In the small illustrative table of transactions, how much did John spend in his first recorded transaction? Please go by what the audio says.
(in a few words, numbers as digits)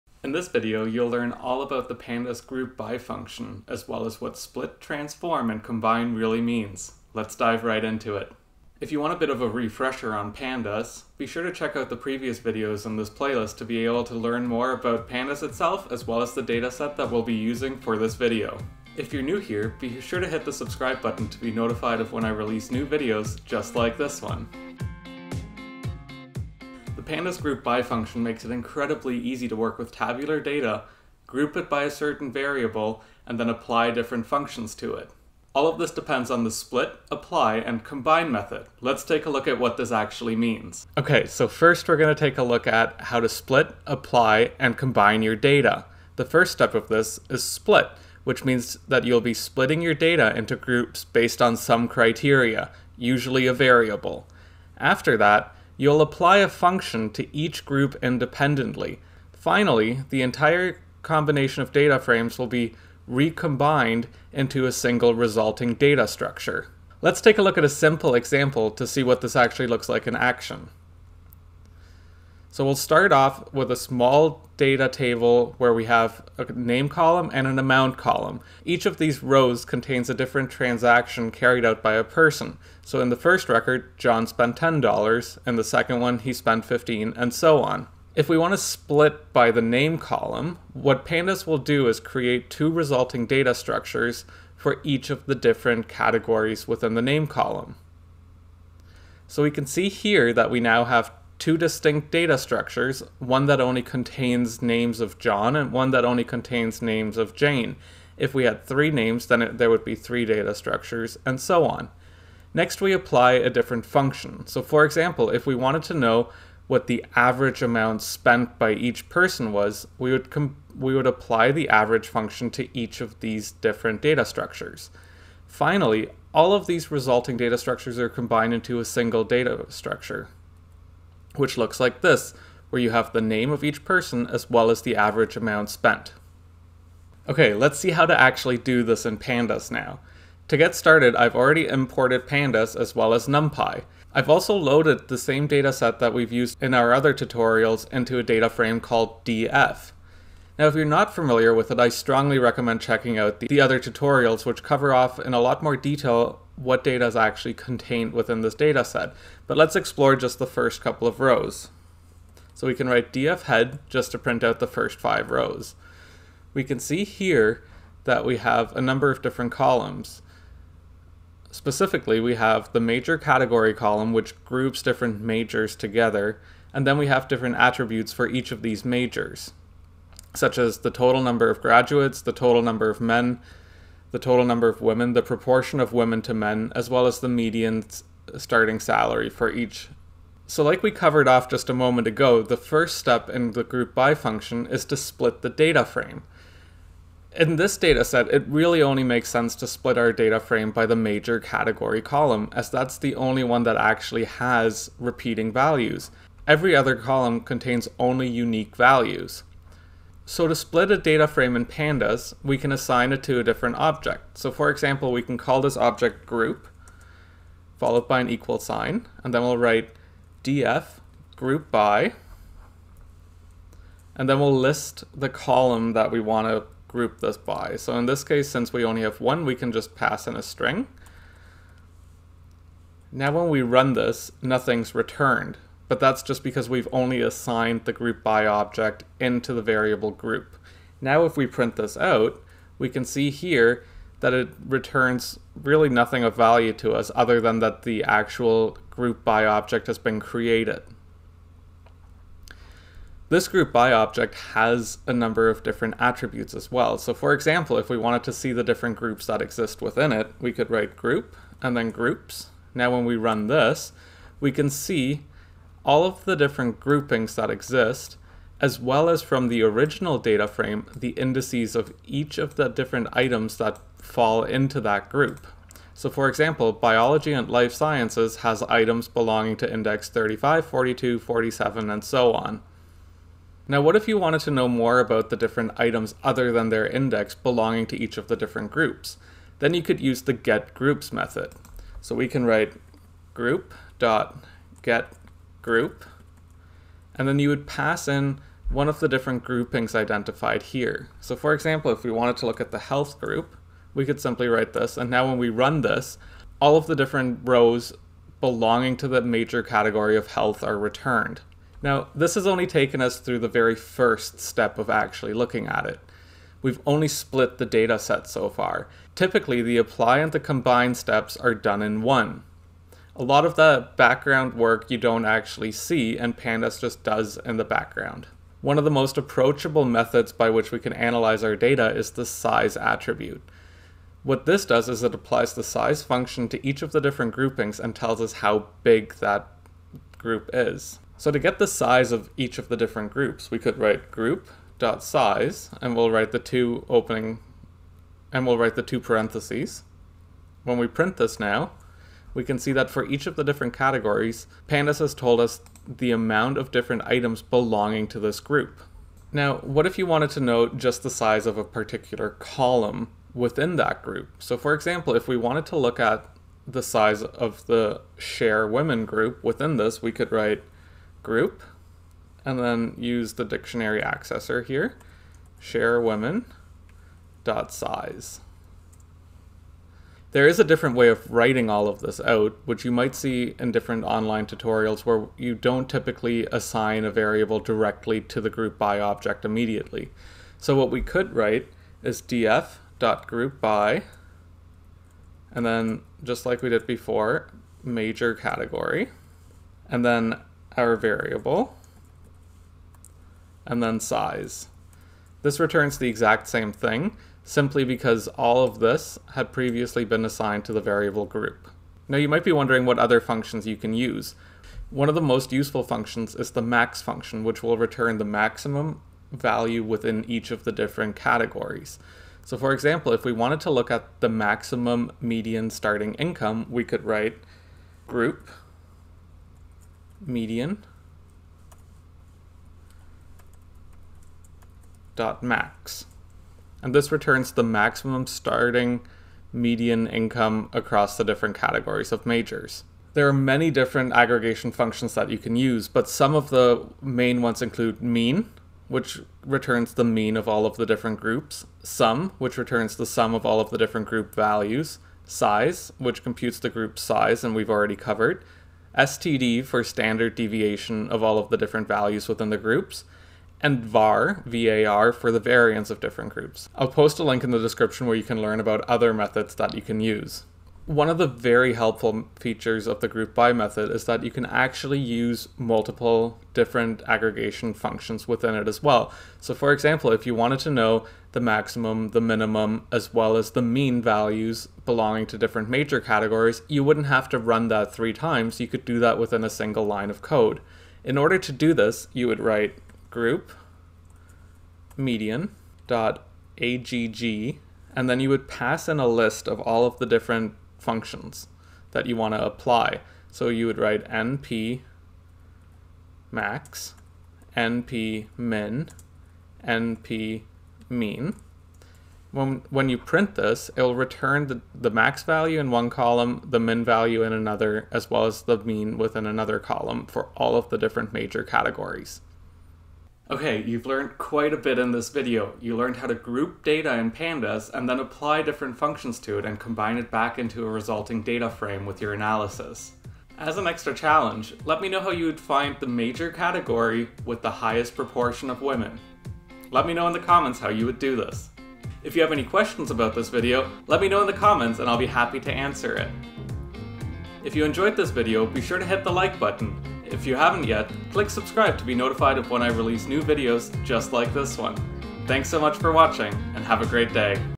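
$10.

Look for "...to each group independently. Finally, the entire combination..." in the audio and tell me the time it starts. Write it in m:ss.
0:57.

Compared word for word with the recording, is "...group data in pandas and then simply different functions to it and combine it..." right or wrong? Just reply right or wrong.
wrong.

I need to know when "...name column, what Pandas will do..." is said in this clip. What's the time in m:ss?
1:29.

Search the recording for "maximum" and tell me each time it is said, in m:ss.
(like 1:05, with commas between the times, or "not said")
6:58, 7:04, 7:17, 8:01.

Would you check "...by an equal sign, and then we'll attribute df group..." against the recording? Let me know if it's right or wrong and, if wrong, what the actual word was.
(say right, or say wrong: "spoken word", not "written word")
wrong: "write", not "attribute".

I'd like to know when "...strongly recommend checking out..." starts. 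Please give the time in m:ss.
2:31.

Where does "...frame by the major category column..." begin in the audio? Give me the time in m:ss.
3:20.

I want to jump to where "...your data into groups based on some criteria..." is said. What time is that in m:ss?
0:49.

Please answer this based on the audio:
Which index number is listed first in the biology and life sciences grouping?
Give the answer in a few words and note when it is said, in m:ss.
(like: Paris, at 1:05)
35, at 4:40.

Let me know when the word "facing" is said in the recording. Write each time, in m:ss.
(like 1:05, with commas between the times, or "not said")
not said.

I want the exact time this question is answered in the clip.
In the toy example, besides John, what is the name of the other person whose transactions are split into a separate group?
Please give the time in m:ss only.
1:47.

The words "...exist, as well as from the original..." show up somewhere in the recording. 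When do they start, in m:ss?
4:27.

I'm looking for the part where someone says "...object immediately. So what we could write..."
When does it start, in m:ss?
6:29.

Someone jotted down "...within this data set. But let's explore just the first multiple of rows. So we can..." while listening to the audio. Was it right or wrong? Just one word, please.
wrong.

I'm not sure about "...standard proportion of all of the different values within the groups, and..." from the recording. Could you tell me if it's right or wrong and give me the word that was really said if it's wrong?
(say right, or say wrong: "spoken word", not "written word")
wrong: "deviation", not "proportion".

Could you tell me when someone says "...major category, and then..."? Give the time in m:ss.
6:37.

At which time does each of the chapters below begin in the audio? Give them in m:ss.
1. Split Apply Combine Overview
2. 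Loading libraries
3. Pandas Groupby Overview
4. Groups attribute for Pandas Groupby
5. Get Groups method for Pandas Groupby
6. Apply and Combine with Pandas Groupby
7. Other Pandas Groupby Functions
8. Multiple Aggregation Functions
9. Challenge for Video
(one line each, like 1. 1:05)
1. 0:40
2. 2:18
3. 3:12
4. 4:16
5. 4:43
6. 5:12
7. 6:54
8. 7:53
9. 8:42.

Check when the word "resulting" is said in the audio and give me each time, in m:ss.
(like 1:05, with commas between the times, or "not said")
1:05, 1:32, 2:06, 8:50.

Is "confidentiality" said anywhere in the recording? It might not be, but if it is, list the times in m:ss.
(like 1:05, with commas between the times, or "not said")
not said.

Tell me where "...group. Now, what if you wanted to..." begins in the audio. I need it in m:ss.
5:58.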